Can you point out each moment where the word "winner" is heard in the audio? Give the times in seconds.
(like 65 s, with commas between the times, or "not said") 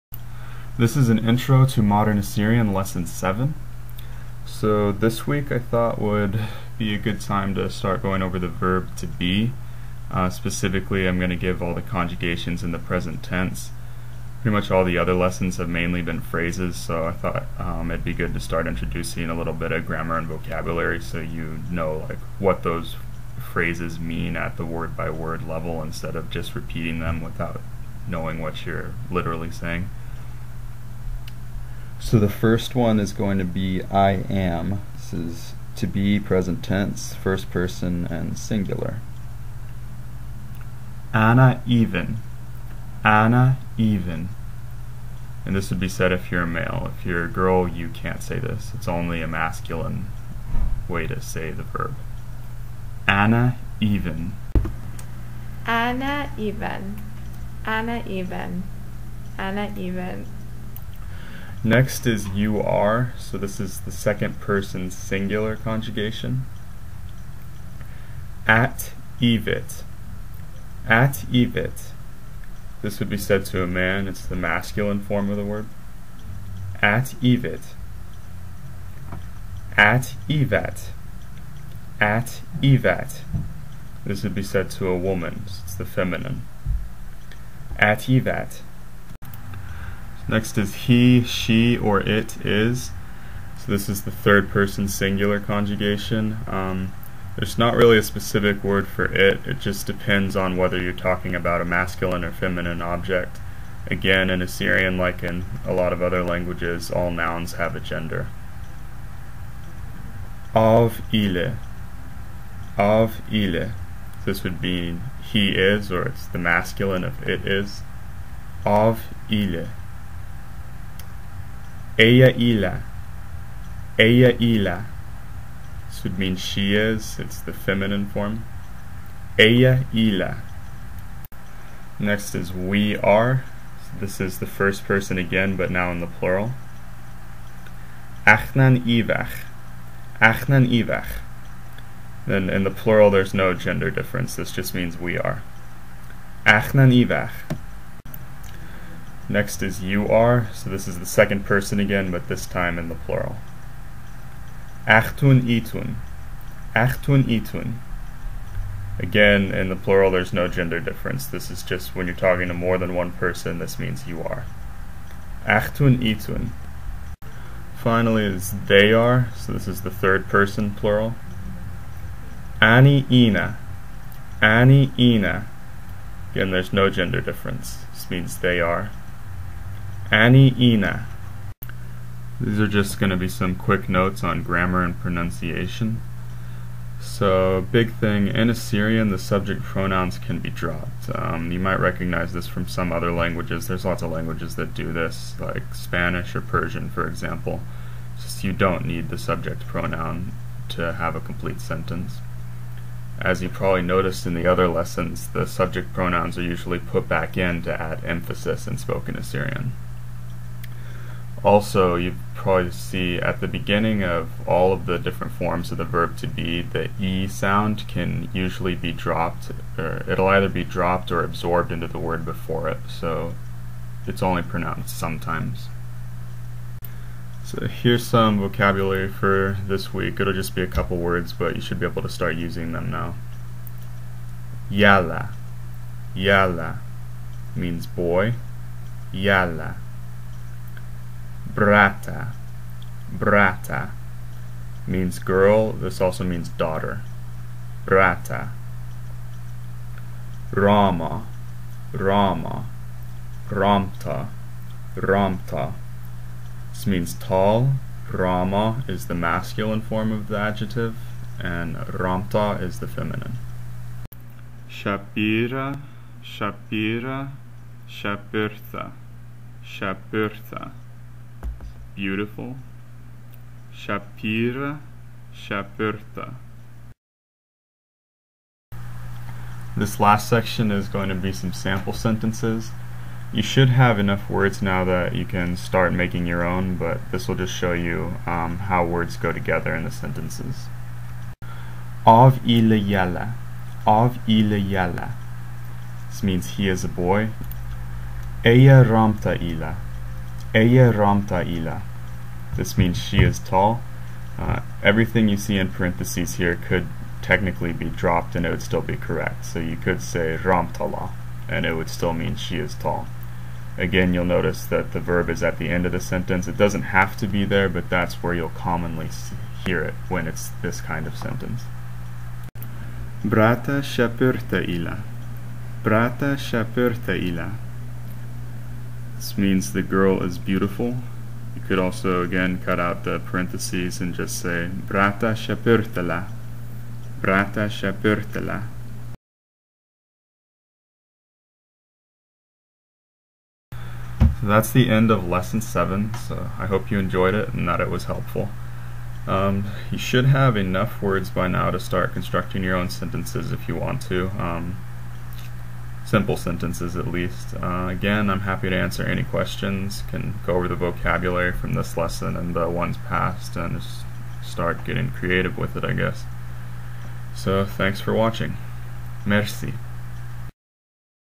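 not said.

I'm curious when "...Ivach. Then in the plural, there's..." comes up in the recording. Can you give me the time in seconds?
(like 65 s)
140 s.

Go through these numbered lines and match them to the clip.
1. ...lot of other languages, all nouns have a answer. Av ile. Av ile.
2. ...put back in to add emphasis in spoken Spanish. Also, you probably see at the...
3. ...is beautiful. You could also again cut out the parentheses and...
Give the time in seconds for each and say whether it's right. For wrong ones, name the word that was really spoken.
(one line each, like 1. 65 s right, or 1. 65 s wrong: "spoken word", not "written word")
1. 105 s wrong: "gender", not "answer"
2. 206 s wrong: "Assyrian", not "Spanish"
3. 330 s right.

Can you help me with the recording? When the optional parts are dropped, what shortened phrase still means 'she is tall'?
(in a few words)
ramtala.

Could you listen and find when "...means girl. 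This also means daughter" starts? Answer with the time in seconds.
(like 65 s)
244 s.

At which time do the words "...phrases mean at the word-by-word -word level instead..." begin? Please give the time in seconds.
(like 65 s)
23 s.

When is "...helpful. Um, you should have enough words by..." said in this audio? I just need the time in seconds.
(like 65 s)
348 s.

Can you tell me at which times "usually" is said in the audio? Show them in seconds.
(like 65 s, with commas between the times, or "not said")
206 s, 218 s.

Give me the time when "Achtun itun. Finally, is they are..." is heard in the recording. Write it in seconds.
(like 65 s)
165 s.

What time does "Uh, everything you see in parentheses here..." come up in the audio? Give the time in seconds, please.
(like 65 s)
304 s.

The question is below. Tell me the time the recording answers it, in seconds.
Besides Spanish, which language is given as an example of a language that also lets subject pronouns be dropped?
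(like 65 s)
196 s.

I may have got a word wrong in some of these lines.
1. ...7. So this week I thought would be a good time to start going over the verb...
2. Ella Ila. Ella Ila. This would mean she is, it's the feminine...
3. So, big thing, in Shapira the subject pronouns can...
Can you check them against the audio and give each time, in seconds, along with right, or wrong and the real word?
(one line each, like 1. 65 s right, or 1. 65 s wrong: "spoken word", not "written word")
1. 3 s right
2. 122 s right
3. 186 s wrong: "Assyrian", not "Shapira".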